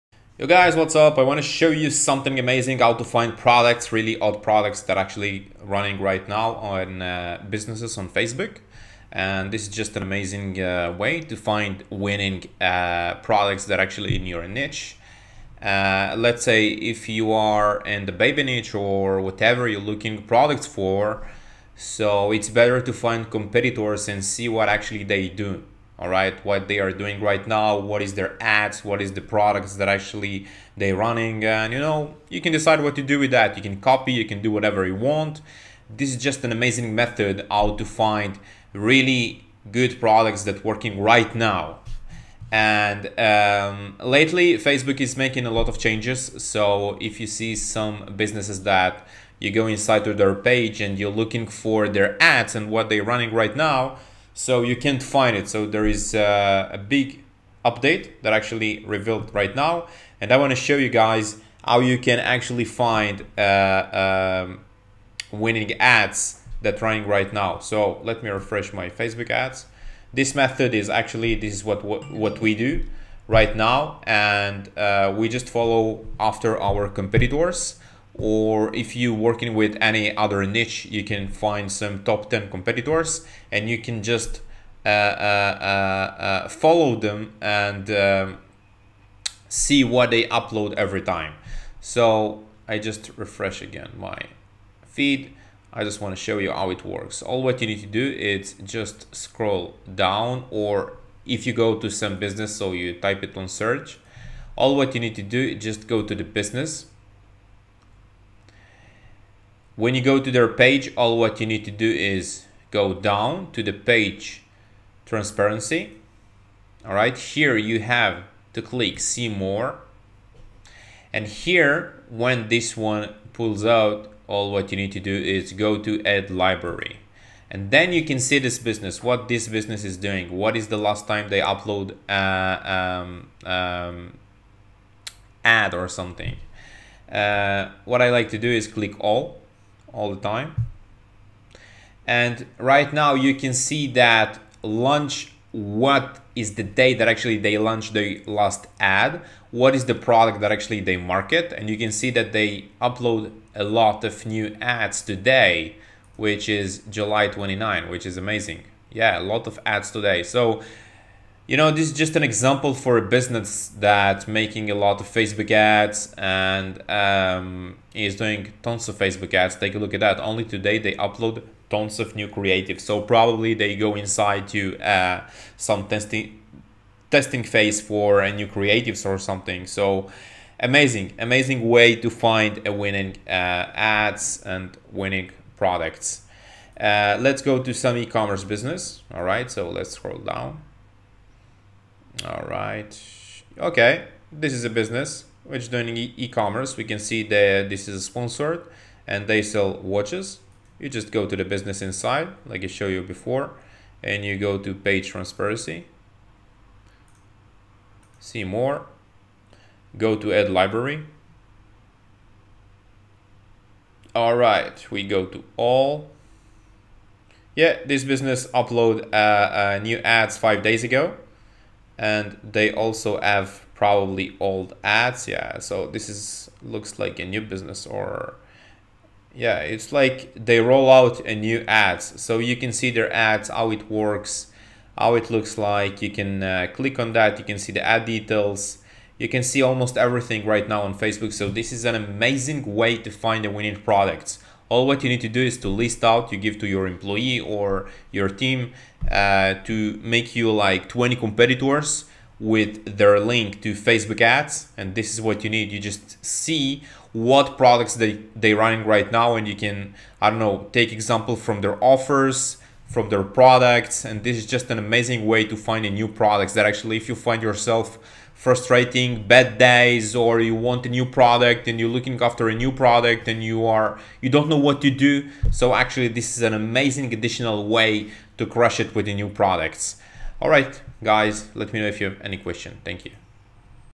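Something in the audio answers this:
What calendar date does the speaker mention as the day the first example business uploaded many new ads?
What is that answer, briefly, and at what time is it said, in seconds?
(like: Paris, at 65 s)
July 29, at 156 s.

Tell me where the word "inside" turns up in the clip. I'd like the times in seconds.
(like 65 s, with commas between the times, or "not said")
49 s, 173 s, 201 s.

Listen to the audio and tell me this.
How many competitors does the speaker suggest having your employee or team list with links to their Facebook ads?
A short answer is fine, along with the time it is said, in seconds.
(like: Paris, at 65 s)
20, at 250 s.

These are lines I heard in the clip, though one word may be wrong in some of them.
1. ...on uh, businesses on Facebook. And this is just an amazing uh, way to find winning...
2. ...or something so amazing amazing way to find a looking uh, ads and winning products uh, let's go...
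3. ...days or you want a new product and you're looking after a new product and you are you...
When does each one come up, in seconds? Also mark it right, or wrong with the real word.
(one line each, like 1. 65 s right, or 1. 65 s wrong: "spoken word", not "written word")
1. 6 s right
2. 179 s wrong: "winning", not "looking"
3. 269 s right.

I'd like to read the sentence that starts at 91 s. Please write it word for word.
So I just refresh again my feed.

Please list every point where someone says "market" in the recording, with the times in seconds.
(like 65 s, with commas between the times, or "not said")
150 s.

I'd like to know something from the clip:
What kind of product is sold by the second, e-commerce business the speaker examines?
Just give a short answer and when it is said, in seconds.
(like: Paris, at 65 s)
Watches, at 199 s.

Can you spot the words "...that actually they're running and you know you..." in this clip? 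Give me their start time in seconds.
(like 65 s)
29 s.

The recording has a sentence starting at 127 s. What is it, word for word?
And then you can see this business, what this business is doing.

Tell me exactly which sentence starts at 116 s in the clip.
All right, here you have to click see more.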